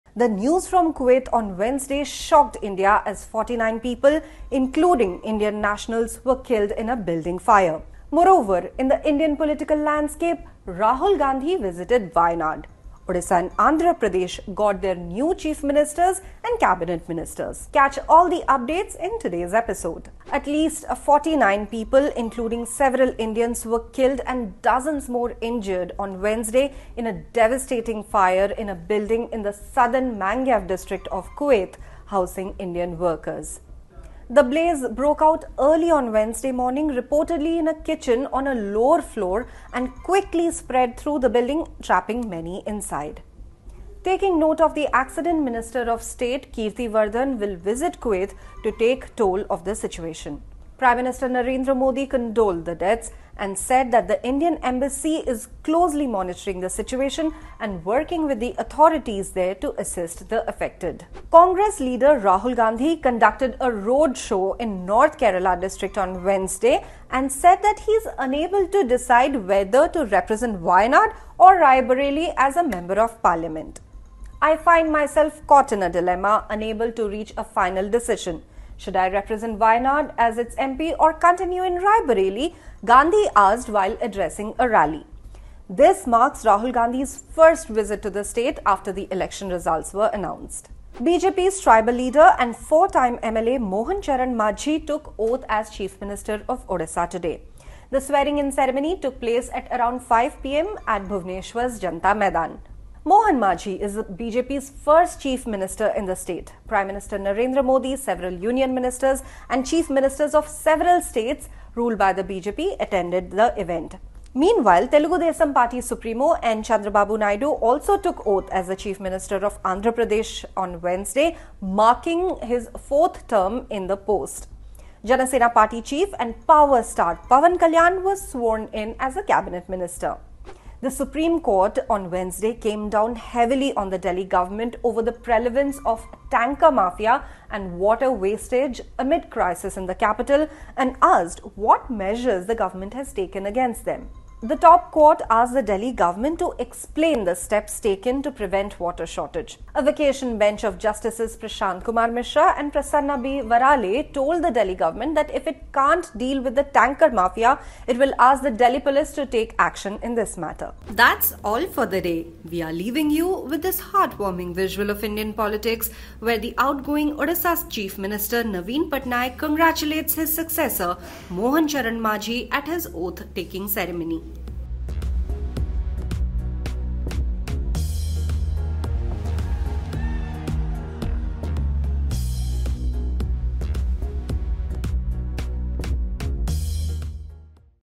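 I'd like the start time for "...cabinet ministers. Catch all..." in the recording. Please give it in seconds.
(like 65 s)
16 s.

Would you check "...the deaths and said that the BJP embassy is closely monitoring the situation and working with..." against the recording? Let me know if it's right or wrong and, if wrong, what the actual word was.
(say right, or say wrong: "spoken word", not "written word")
wrong: "Indian", not "BJP".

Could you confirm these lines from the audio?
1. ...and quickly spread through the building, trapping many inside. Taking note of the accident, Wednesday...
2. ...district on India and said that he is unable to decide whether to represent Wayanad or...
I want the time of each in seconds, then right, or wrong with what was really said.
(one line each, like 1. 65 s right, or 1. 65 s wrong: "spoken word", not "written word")
1. 39 s wrong: "Minister", not "Wednesday"
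2. 65 s wrong: "Wednesday", not "India".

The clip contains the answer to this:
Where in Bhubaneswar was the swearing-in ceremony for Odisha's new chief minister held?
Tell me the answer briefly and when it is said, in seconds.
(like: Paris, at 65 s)
Janta Maidan, at 101 s.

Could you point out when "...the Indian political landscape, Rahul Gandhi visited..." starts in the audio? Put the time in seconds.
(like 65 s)
8 s.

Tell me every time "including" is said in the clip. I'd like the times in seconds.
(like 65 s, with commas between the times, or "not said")
4 s, 22 s.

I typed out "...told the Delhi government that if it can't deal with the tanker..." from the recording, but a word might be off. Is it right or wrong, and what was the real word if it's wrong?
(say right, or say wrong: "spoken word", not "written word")
right.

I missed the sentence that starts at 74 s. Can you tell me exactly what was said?
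I find myself caught in a dilemma, unable to reach a final decision.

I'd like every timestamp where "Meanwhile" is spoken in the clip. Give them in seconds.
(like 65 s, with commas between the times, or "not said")
114 s.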